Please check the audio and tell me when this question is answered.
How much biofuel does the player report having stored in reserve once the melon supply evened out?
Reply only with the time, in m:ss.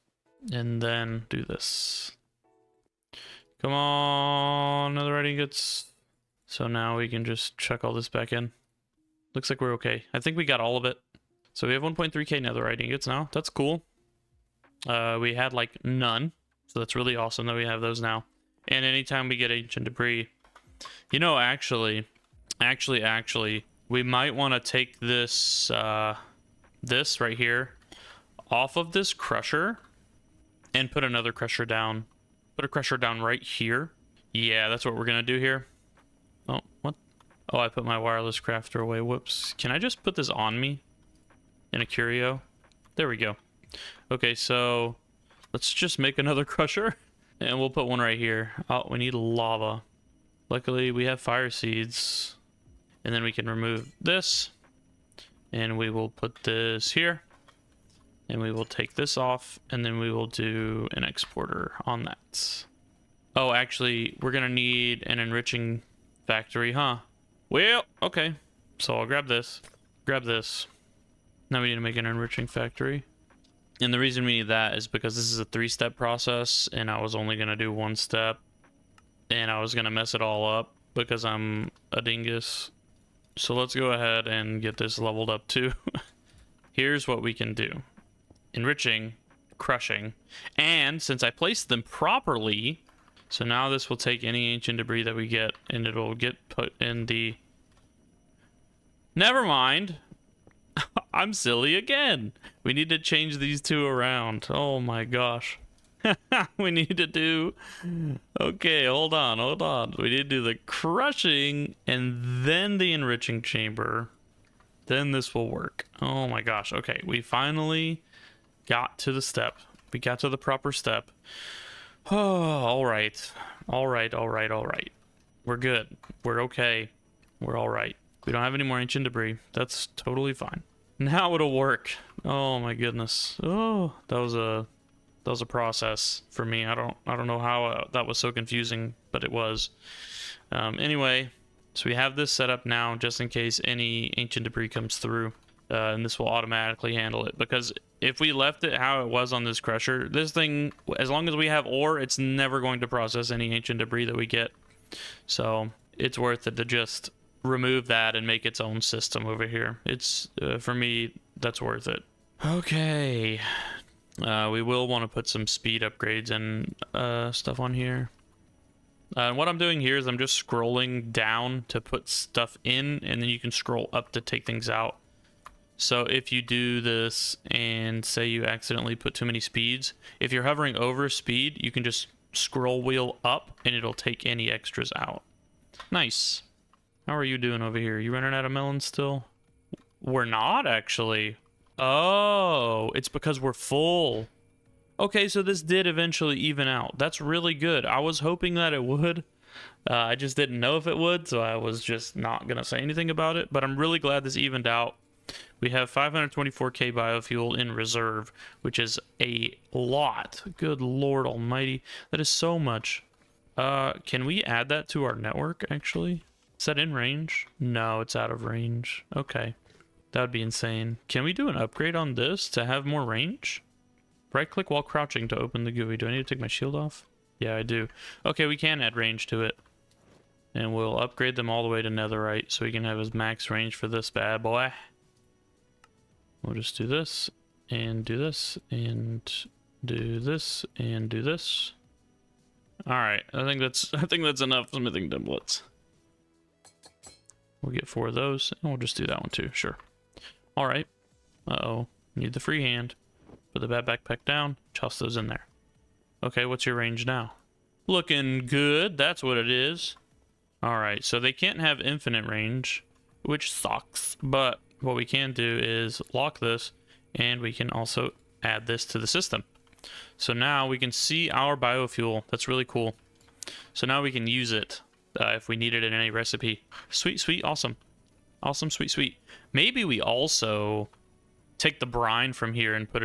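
3:25.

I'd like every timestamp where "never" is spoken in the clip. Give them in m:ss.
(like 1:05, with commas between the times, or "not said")
1:39, 2:32.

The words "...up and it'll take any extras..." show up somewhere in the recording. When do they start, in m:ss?
3:03.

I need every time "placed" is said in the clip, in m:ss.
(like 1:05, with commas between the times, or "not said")
1:31.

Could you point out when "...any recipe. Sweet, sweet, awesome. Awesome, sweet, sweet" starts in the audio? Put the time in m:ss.
4:35.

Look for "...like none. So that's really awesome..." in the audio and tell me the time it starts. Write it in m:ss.
0:15.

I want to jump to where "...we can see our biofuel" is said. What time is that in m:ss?
4:30.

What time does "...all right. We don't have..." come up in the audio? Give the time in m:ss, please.
2:07.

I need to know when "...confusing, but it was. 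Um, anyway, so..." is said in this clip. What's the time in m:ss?
2:18.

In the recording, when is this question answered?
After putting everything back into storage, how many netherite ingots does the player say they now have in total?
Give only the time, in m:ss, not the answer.
0:11.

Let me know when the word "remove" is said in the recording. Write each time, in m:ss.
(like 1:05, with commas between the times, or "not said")
0:53, 2:37.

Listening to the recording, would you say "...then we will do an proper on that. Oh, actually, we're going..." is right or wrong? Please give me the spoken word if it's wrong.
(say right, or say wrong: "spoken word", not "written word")
wrong: "exporter", not "proper".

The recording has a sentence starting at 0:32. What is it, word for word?
Put a crusher down right here.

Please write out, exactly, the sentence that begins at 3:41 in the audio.
Can we do an upgrade on this to have more range?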